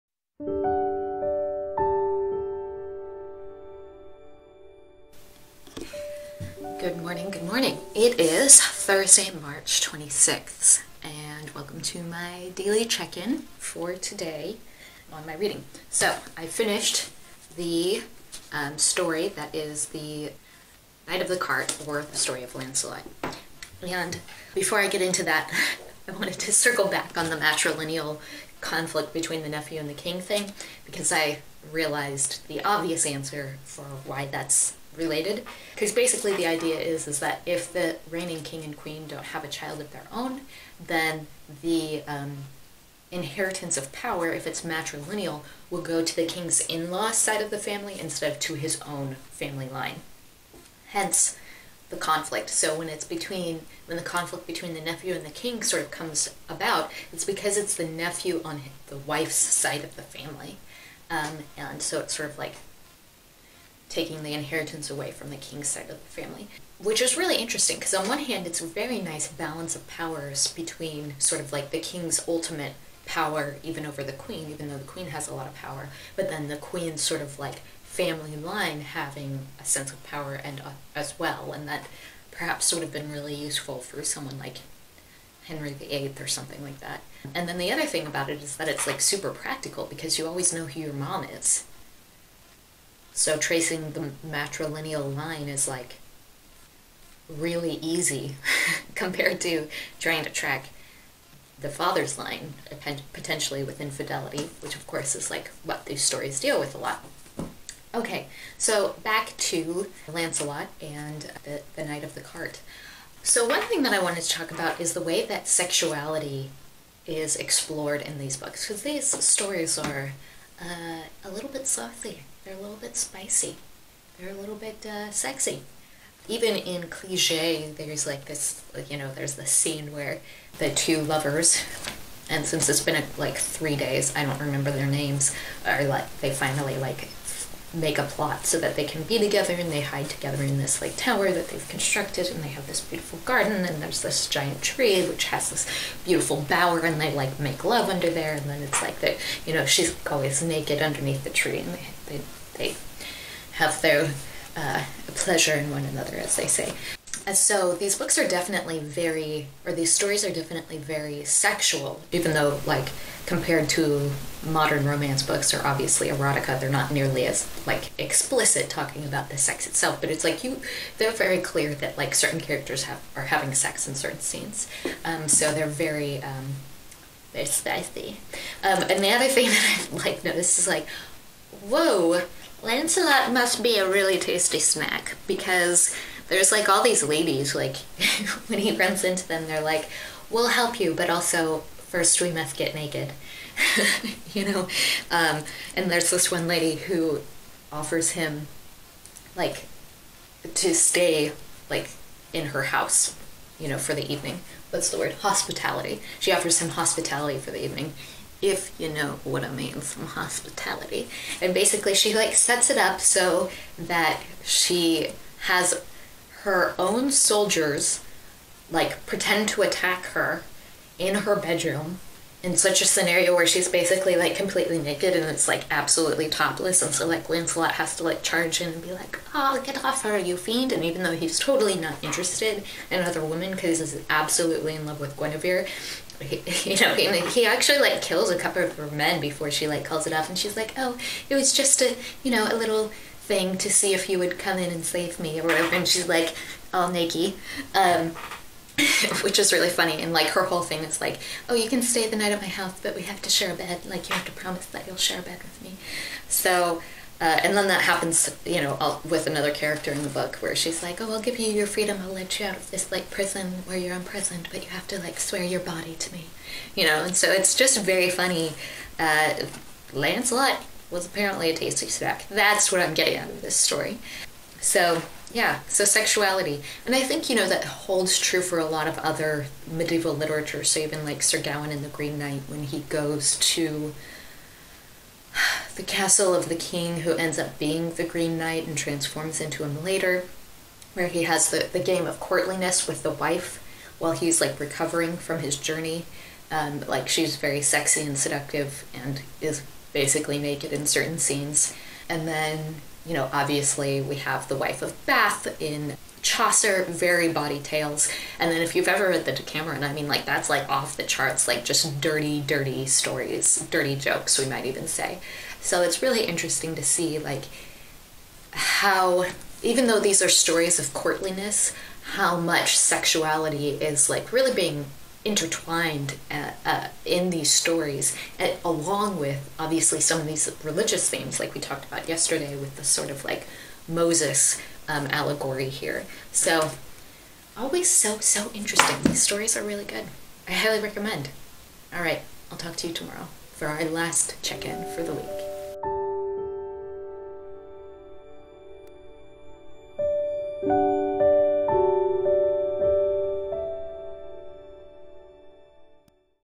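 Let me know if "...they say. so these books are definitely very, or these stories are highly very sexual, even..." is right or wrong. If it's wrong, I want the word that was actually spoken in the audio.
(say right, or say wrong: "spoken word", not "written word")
wrong: "definitely", not "highly".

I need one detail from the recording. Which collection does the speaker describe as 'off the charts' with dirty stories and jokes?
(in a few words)
The Decameron.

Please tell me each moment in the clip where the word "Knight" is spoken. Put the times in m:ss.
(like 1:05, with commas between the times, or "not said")
0:21, 1:51, 4:42, 4:48.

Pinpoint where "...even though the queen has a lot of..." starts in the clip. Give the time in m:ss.
1:14.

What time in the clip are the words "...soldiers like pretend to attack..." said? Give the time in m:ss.
3:37.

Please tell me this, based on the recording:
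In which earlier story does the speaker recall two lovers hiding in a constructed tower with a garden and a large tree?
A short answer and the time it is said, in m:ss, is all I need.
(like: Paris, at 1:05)
Cligès, at 2:06.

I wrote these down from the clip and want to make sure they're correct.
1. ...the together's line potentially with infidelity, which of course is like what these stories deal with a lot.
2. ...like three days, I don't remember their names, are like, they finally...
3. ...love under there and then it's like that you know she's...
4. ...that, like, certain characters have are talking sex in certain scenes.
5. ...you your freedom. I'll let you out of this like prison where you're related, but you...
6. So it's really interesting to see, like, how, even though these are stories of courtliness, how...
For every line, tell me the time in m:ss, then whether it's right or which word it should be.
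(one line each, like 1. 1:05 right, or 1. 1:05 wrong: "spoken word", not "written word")
1. 1:41 wrong: "father", not "together"
2. 2:13 right
3. 2:27 right
4. 2:51 wrong: "having", not "talking"
5. 4:21 wrong: "imprisoned", not "related"
6. 5:15 right.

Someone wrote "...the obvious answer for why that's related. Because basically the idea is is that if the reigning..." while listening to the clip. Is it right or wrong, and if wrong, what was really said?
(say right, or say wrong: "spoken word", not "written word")
right.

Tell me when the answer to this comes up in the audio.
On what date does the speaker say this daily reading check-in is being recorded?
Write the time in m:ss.
0:09.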